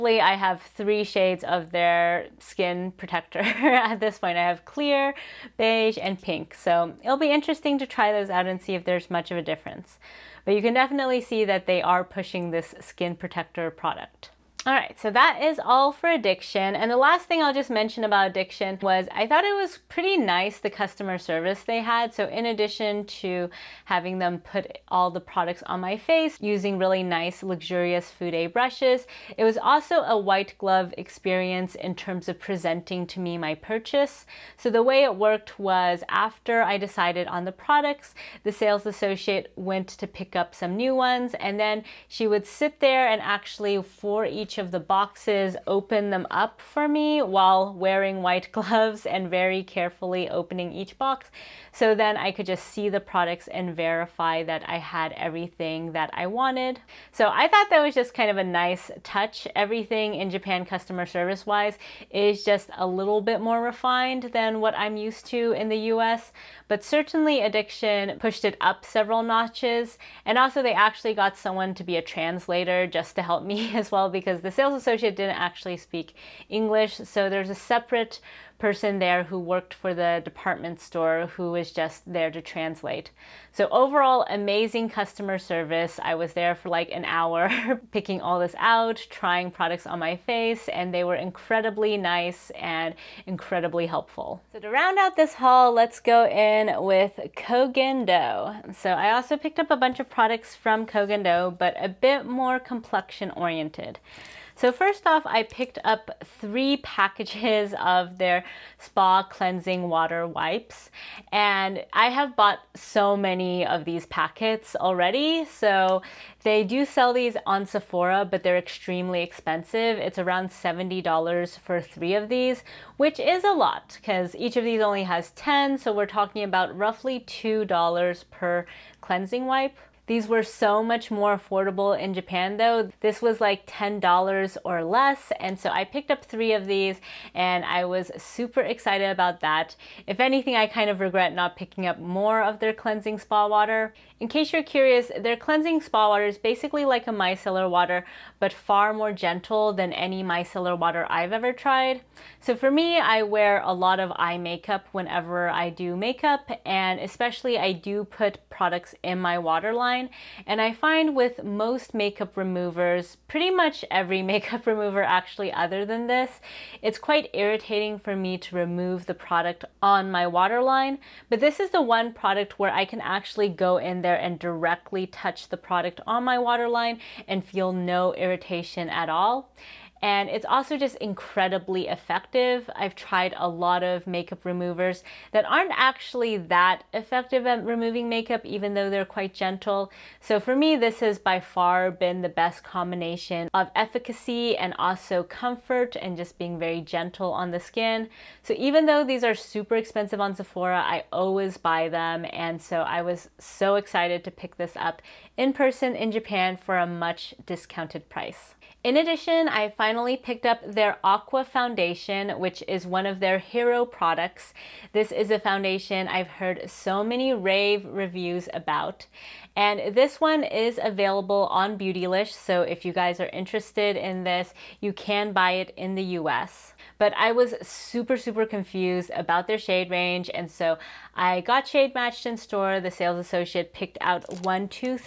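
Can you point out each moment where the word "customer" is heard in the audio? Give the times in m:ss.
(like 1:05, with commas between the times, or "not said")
0:20, 1:00, 1:24.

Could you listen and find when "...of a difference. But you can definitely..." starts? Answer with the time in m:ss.
0:09.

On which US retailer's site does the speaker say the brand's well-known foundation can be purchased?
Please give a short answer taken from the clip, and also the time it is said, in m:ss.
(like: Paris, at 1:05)
Beautylish, at 3:41.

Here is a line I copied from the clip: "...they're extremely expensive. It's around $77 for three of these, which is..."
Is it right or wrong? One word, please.
wrong.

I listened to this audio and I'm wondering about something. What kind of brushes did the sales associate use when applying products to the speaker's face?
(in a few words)
fude brushes.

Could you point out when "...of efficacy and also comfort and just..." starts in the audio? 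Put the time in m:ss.
3:13.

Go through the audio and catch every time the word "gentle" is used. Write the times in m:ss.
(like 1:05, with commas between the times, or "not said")
2:29, 3:09, 3:16.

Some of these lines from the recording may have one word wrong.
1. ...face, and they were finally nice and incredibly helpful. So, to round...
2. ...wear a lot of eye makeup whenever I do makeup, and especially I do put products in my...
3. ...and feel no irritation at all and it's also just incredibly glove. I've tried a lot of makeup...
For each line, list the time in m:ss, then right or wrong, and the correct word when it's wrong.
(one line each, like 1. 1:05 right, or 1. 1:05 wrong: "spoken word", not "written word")
1. 1:30 wrong: "incredibly", not "finally"
2. 2:33 right
3. 2:57 wrong: "effective", not "glove".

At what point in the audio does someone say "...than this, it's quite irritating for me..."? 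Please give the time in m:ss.
2:45.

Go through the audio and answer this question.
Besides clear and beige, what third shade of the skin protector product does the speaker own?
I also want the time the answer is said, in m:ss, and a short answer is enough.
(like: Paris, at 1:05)
pink, at 0:06.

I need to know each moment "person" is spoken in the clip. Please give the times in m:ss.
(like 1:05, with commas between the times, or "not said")
1:18, 3:25.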